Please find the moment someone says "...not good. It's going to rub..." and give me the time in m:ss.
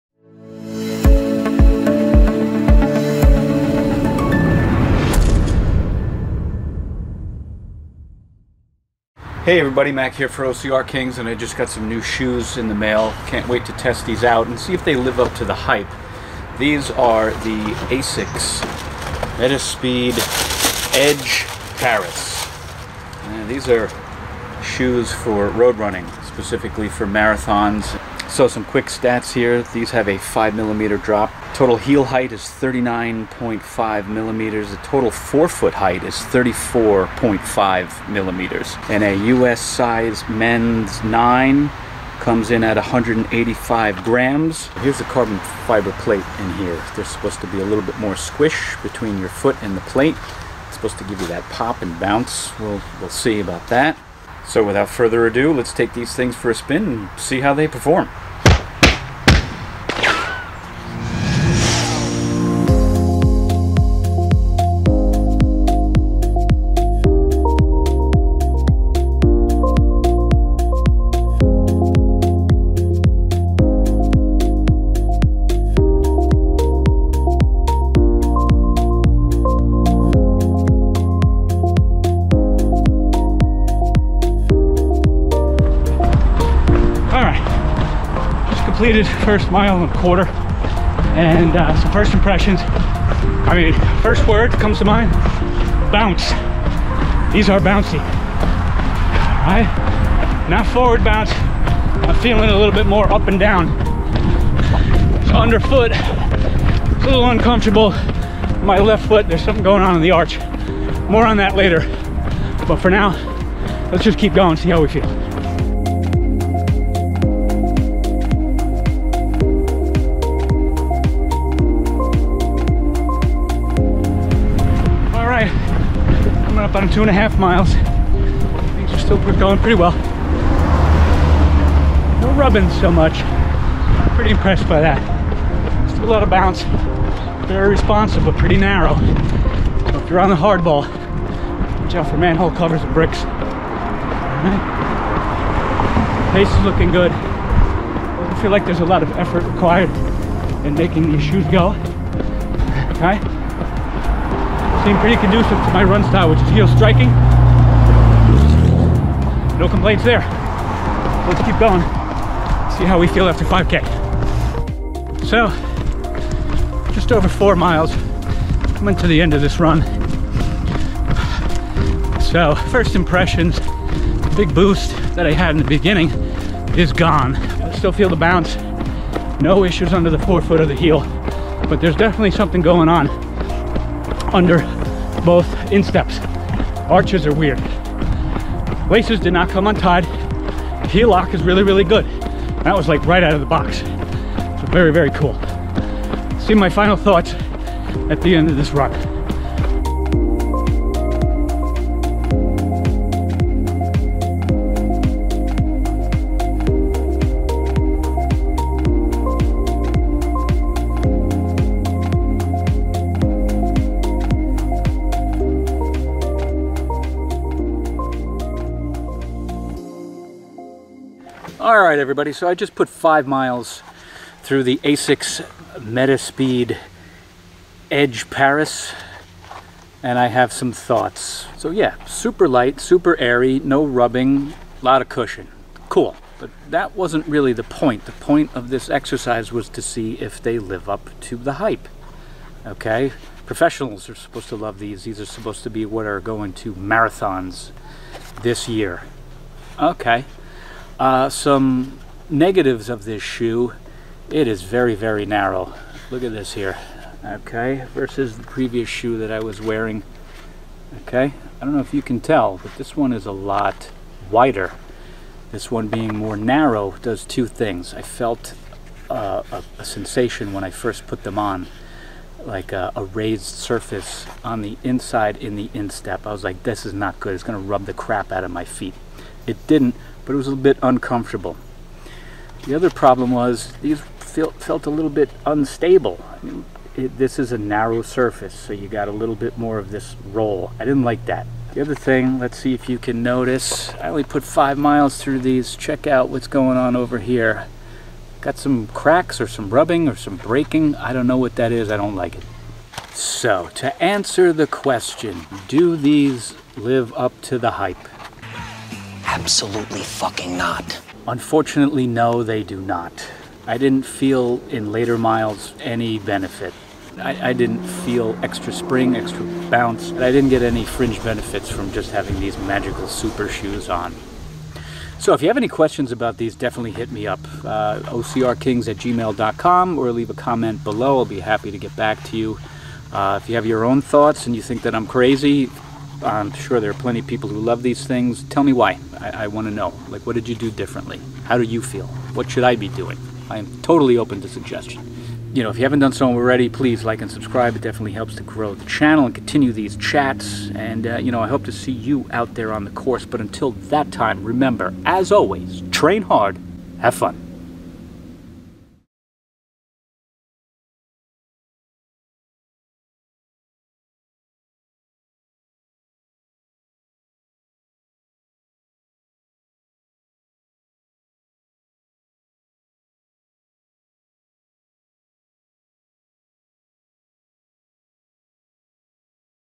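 4:36.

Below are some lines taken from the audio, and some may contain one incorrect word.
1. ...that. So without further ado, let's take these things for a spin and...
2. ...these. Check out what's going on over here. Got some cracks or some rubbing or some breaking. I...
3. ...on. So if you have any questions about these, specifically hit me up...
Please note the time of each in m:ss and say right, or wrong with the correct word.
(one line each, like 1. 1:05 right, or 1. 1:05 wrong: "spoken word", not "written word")
1. 0:53 right
2. 4:55 right
3. 5:23 wrong: "definitely", not "specifically".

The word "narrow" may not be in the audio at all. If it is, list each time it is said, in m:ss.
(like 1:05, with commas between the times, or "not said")
2:18, 4:15, 4:26, 4:47.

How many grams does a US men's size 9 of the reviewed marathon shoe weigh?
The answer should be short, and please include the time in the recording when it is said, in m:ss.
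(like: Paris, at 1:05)
185 grams, at 0:42.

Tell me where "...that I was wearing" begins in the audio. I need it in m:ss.
4:19.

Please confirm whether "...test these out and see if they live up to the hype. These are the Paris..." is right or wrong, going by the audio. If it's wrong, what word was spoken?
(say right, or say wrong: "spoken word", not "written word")
wrong: "ASICS", not "Paris".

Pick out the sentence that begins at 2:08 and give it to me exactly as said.
Things are still going pretty well.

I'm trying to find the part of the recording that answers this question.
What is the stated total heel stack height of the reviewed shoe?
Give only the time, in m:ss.
0:32.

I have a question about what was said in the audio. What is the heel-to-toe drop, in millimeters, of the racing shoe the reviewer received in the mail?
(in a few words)
5 millimeters.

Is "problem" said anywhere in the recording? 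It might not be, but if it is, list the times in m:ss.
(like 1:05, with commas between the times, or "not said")
4:42.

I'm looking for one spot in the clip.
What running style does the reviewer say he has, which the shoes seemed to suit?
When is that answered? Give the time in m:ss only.
2:36.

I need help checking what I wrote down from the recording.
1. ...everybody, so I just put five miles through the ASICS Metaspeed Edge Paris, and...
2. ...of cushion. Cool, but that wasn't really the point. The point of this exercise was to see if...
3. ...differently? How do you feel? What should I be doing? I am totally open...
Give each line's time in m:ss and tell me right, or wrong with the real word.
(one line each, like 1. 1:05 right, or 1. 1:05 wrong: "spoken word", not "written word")
1. 3:41 right
2. 3:55 right
3. 5:40 right.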